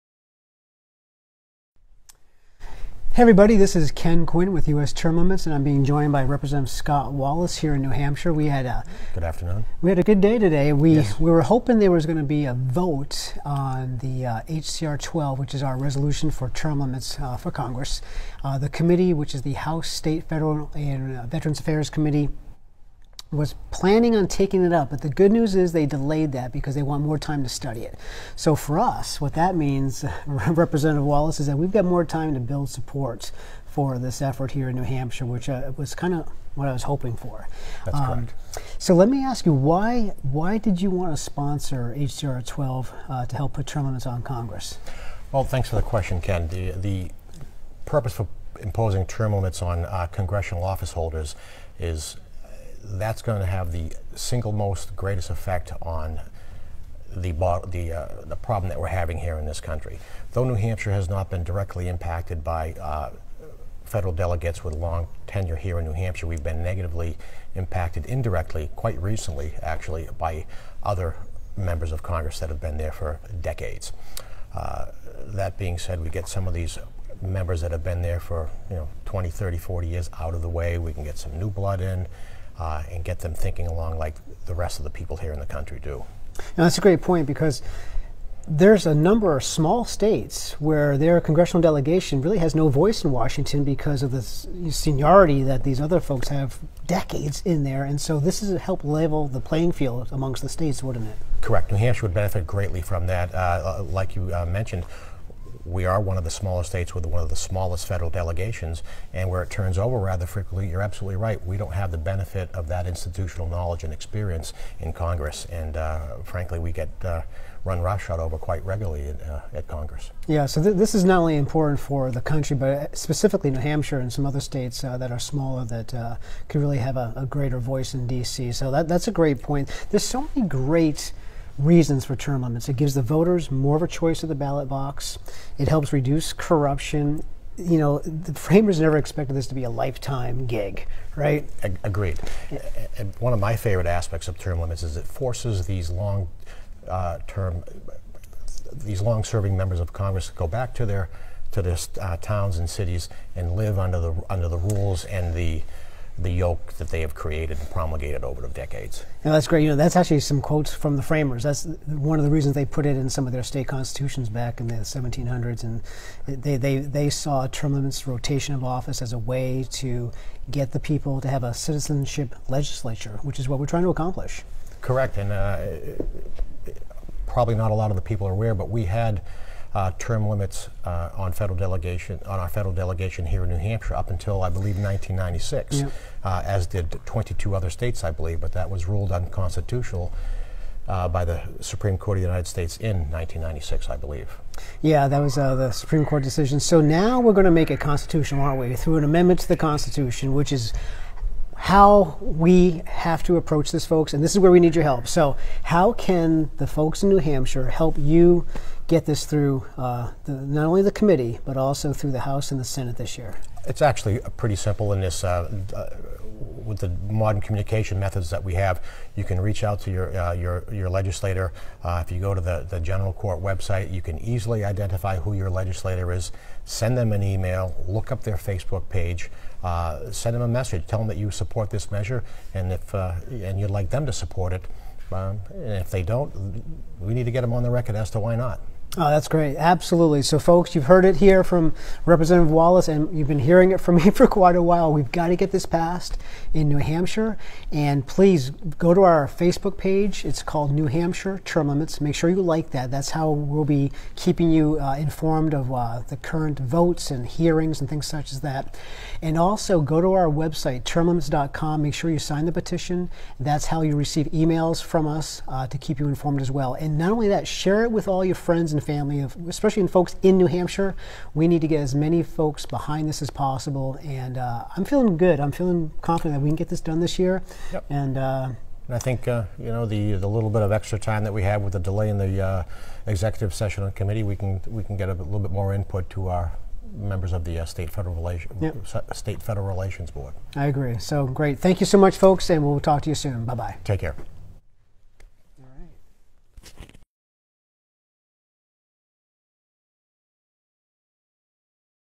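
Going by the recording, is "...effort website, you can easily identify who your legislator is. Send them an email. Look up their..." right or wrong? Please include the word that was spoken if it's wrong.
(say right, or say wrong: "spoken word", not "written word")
wrong: "court", not "effort".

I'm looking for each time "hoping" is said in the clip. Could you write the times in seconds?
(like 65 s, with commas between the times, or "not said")
11 s, 36 s.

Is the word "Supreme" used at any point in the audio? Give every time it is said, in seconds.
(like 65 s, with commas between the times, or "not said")
191 s, 195 s.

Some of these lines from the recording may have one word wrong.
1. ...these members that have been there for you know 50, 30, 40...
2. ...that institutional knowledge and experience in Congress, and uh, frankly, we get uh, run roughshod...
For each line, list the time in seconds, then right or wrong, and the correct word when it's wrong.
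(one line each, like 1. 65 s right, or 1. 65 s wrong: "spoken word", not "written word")
1. 76 s wrong: "20", not "50"
2. 112 s right.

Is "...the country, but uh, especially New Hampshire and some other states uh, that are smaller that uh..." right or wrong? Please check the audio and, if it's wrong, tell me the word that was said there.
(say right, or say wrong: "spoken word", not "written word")
wrong: "specifically", not "especially".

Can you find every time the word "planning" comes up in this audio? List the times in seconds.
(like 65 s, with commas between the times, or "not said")
23 s.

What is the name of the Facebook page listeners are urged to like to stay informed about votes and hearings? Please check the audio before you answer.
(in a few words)
New Hampshire Term Limits.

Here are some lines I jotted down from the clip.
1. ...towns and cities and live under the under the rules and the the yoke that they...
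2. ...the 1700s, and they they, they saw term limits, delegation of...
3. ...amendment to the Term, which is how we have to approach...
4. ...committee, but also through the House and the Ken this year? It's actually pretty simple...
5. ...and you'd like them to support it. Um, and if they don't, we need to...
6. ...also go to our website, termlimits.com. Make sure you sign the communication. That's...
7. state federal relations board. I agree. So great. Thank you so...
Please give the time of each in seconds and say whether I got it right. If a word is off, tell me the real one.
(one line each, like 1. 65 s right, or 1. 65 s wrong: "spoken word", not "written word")
1. 152 s right
2. 164 s wrong: "rotation", not "delegation"
3. 199 s wrong: "Constitution", not "Term"
4. 210 s wrong: "Senate", not "Ken"
5. 233 s right
6. 259 s wrong: "petition", not "communication"
7. 289 s right.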